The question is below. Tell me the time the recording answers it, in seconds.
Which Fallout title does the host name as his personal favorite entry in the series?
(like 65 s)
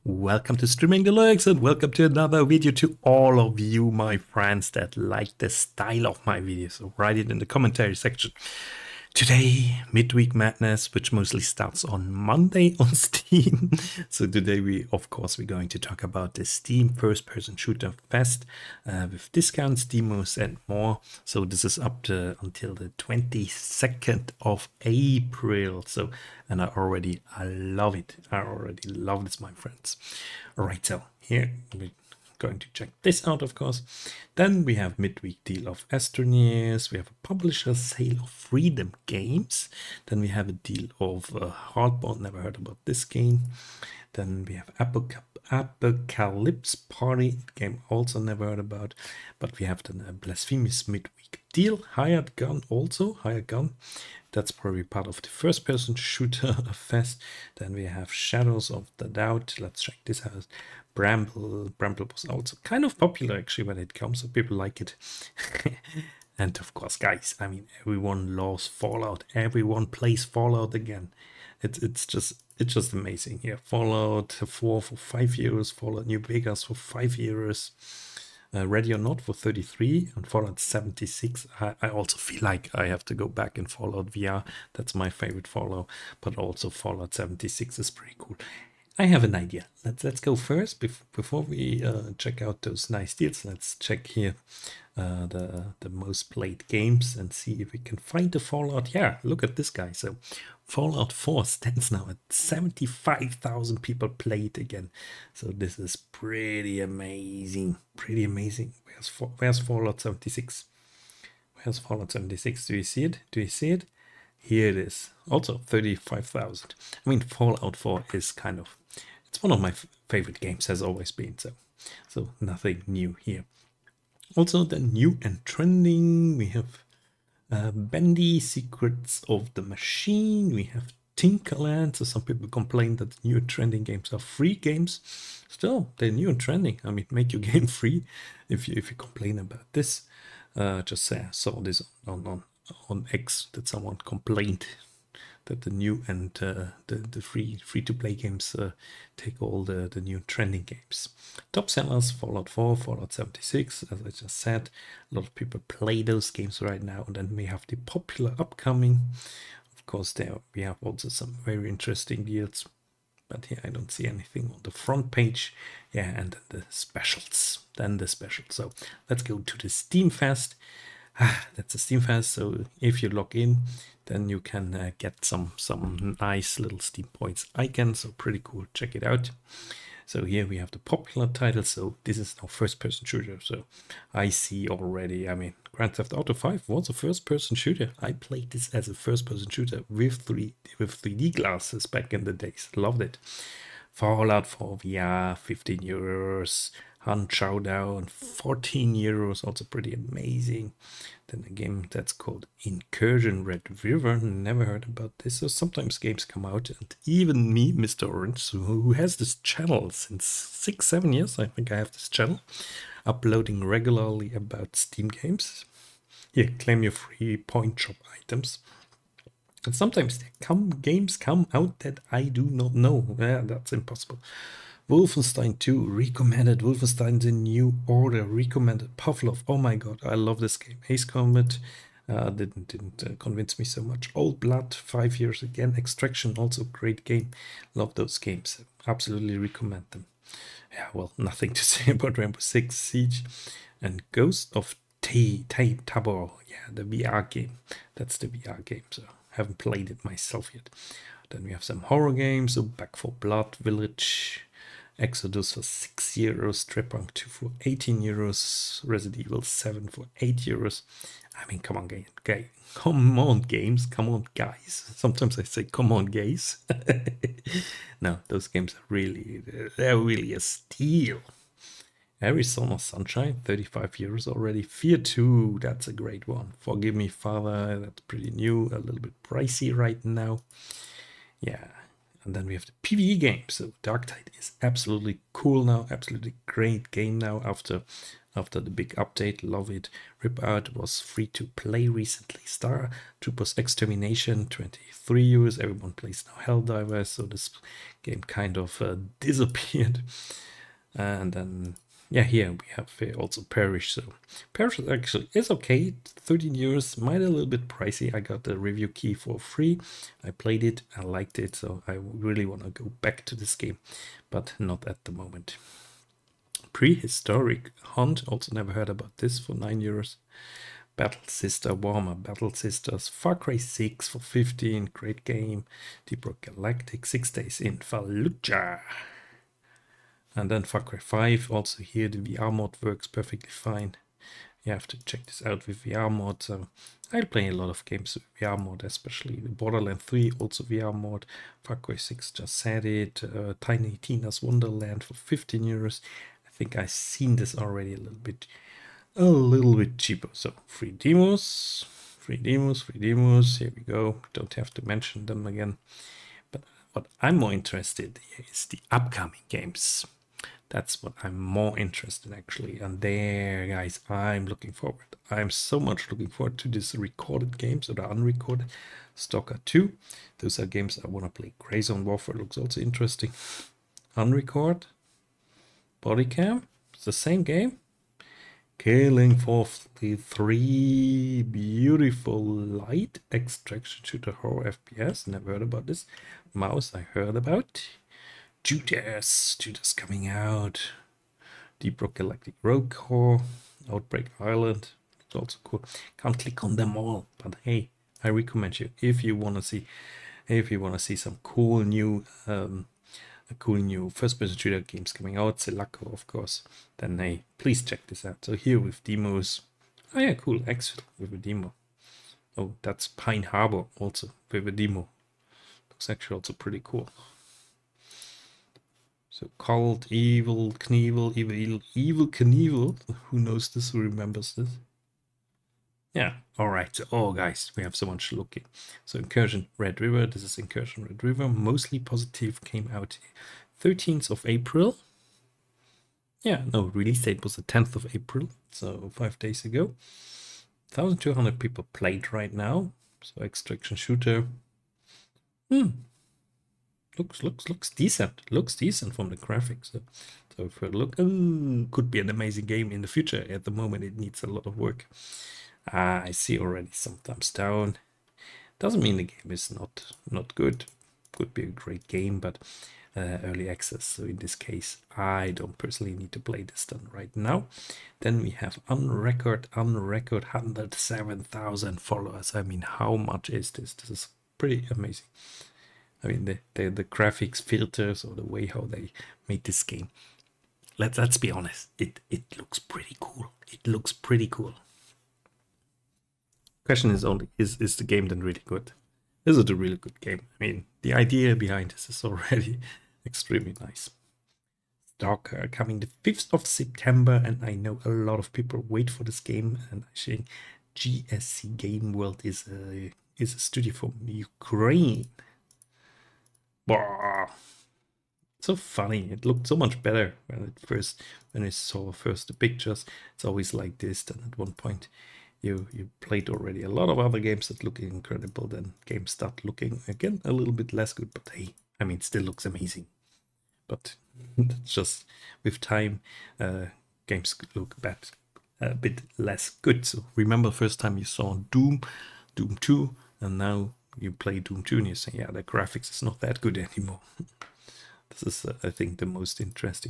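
83 s.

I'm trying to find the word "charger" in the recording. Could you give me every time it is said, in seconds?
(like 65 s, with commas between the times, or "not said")
not said.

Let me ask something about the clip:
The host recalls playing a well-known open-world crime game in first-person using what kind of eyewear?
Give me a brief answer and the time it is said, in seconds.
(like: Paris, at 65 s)
3D glasses, at 191 s.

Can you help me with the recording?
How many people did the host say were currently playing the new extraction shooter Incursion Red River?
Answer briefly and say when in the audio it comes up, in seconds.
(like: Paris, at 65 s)
1,200, at 440 s.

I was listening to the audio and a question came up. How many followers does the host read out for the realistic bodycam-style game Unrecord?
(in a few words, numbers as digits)
107,000.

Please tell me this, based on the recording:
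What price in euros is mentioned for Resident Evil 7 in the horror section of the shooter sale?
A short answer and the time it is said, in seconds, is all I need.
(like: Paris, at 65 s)
8 euros, at 260 s.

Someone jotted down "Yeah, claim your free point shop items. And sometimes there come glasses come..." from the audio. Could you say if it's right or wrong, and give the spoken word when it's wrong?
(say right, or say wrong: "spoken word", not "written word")
wrong: "games", not "glasses".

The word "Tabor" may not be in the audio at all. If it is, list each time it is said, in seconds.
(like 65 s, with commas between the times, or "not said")
245 s.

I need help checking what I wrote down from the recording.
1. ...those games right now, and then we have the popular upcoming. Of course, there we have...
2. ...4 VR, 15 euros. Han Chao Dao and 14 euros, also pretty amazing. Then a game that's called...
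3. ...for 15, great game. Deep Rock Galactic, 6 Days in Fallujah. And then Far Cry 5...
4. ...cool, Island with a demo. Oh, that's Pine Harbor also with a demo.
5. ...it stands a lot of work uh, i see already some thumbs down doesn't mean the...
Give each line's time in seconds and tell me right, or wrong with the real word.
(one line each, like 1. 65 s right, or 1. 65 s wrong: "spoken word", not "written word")
1. 156 s right
2. 194 s right
3. 324 s right
4. 410 s wrong: "Exit", not "Island"
5. 454 s wrong: "needs", not "stands".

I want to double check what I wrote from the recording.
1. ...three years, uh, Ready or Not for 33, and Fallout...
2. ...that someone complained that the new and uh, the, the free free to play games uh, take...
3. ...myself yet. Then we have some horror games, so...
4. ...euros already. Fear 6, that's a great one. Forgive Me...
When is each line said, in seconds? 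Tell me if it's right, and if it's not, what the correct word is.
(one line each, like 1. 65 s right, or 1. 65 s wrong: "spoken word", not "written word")
1. 76 s wrong: "five", not "three"
2. 143 s right
3. 250 s right
4. 273 s wrong: "2", not "6".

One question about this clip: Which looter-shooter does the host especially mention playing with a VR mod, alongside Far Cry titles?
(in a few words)
Borderlands 3.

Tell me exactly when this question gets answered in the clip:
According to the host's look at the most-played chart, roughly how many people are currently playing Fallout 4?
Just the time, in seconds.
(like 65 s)
102 s.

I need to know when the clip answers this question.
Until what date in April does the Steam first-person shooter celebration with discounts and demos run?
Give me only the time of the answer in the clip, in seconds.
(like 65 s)
22 s.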